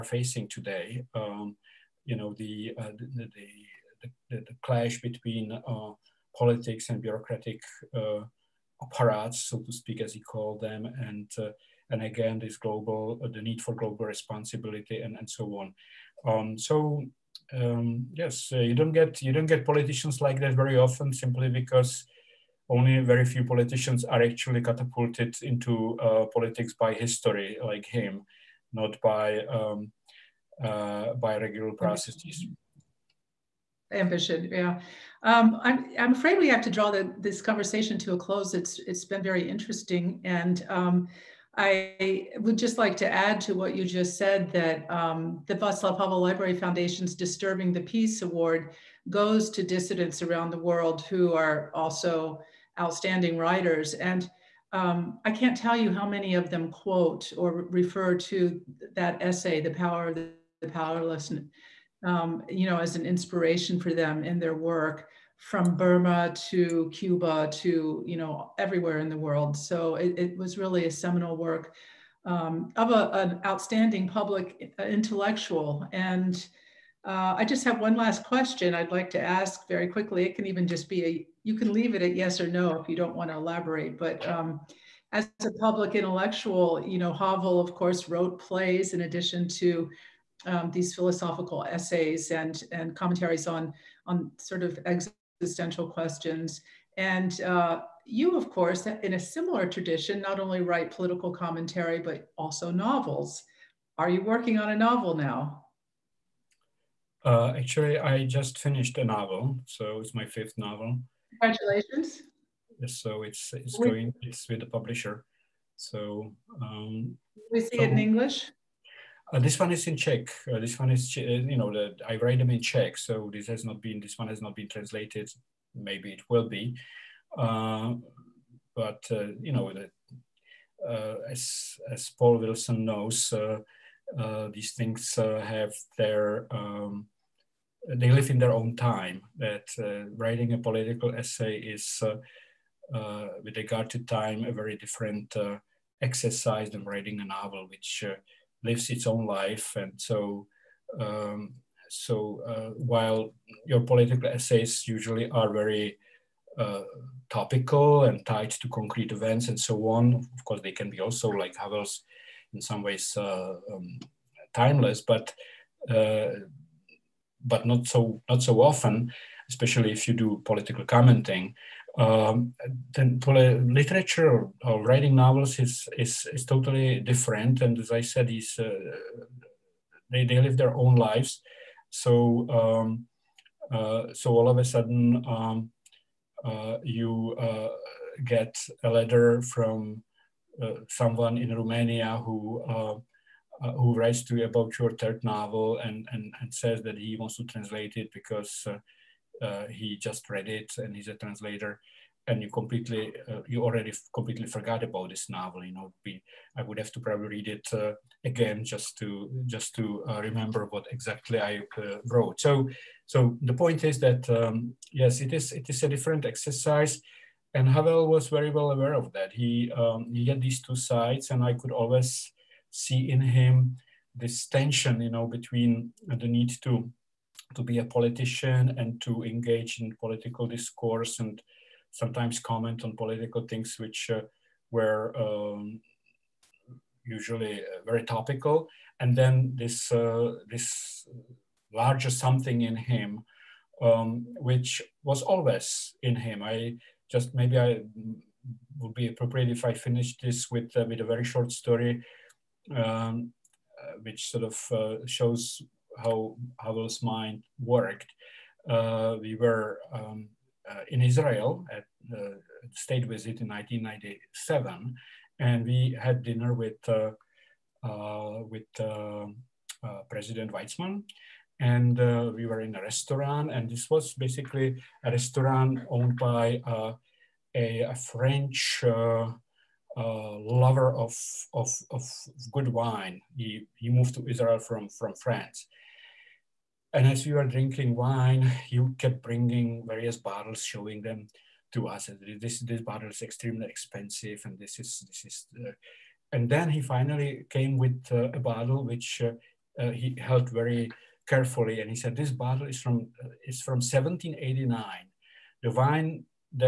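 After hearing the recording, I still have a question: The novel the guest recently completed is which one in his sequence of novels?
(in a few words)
fifth.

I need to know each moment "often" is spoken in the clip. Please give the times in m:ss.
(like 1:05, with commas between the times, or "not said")
0:20, 2:48.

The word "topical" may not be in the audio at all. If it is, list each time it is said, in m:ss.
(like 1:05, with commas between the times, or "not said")
2:37, 3:58.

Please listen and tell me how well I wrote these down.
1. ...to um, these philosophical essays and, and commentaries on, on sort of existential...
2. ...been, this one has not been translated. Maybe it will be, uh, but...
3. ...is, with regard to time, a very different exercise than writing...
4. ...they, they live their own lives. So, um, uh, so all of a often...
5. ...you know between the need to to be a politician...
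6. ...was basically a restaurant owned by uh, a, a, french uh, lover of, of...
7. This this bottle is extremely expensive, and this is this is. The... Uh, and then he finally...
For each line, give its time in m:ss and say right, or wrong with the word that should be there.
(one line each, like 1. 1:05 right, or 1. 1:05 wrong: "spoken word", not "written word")
1. 1:29 right
2. 2:03 right
3. 2:21 right
4. 3:00 wrong: "sudden", not "often"
5. 3:45 right
6. 4:33 right
7. 4:52 right.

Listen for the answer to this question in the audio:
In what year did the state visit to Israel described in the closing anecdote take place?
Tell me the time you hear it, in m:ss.
4:23.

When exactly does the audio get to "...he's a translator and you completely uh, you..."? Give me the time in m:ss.
3:20.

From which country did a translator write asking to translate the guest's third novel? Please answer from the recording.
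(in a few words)
Romania.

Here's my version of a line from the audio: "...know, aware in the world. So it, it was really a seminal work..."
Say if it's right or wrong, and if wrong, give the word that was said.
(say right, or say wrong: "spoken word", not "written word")
wrong: "everywhere", not "aware".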